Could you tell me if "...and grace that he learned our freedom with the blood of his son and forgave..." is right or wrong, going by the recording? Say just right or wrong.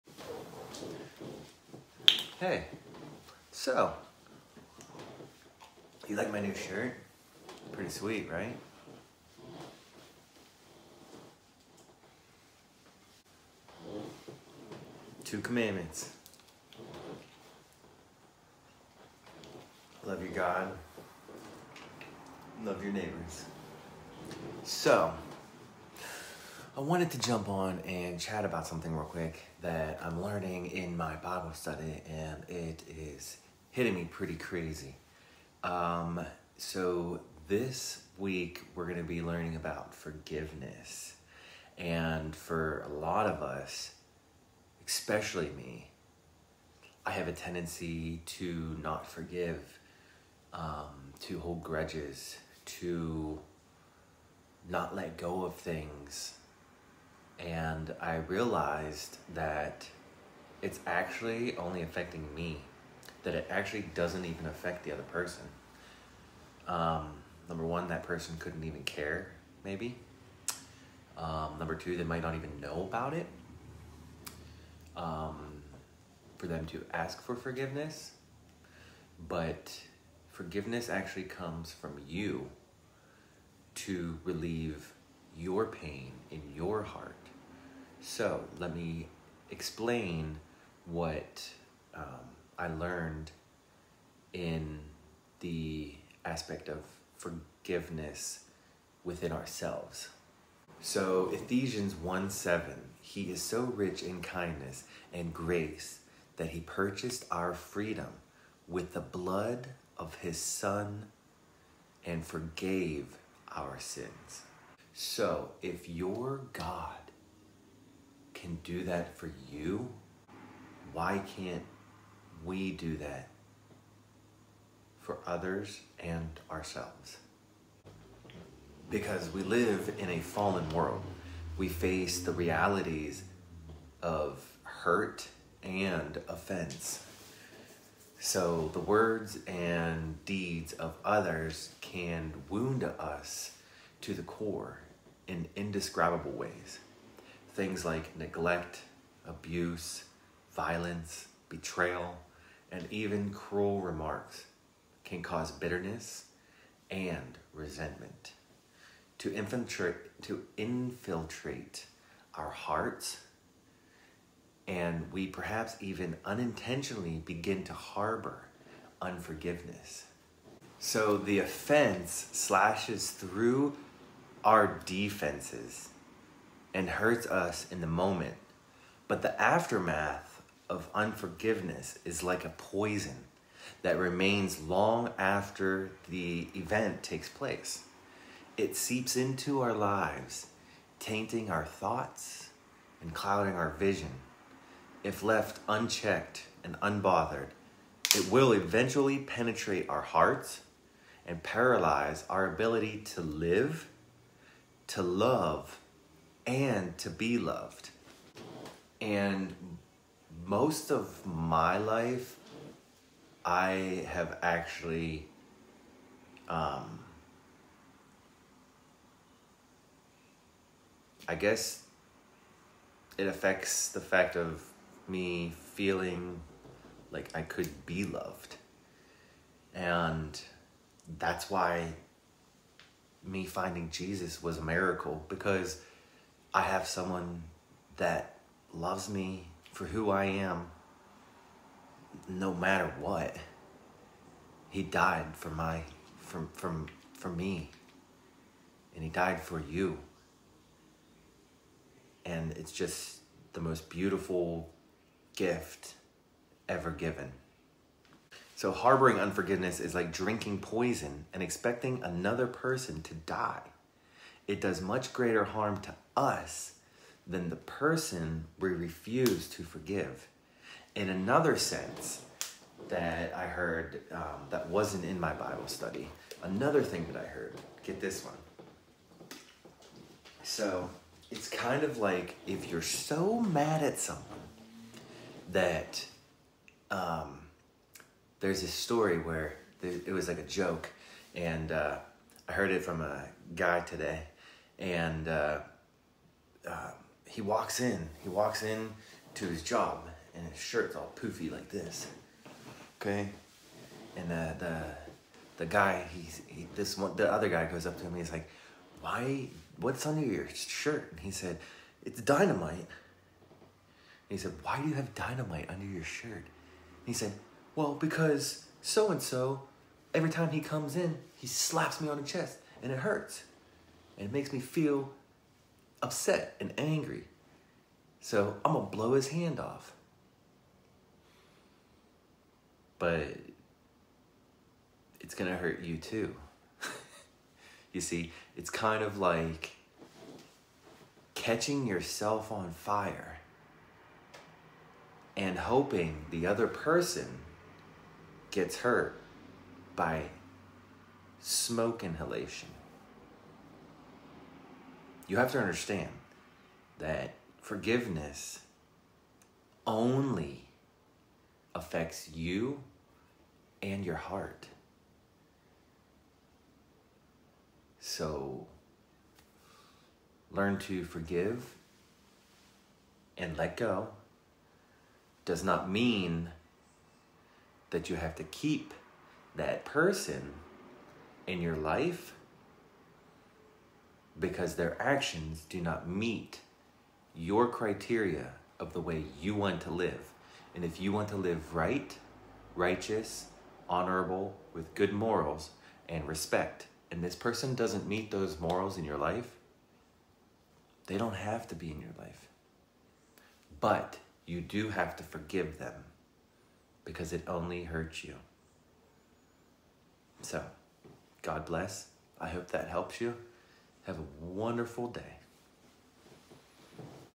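wrong.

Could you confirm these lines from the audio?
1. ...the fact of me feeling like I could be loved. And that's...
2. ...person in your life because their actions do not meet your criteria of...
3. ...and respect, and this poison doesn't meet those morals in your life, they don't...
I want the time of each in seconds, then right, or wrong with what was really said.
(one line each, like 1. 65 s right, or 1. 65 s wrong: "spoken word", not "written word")
1. 223 s right
2. 379 s right
3. 396 s wrong: "person", not "poison".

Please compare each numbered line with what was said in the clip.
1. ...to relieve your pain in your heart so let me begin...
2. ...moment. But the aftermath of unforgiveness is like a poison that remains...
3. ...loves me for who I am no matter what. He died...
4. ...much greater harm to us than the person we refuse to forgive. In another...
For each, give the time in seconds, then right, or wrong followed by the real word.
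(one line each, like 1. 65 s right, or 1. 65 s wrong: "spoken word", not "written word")
1. 83 s wrong: "explain", not "begin"
2. 177 s right
3. 238 s right
4. 264 s right.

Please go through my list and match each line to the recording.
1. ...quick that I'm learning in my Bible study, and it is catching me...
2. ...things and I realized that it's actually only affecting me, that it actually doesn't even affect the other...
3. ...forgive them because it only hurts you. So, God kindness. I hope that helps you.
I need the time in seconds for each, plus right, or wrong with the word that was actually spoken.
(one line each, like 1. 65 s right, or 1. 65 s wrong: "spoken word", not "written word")
1. 29 s wrong: "hitting", not "catching"
2. 55 s right
3. 405 s wrong: "bless", not "kindness".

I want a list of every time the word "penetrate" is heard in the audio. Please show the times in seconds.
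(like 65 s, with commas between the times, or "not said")
199 s.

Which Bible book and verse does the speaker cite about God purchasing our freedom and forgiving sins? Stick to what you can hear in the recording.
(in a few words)
Ephesians 1:7.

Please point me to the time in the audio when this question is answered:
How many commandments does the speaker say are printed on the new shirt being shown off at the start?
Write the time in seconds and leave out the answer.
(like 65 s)
15 s.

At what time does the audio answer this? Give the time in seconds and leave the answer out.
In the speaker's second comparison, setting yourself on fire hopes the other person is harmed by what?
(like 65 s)
351 s.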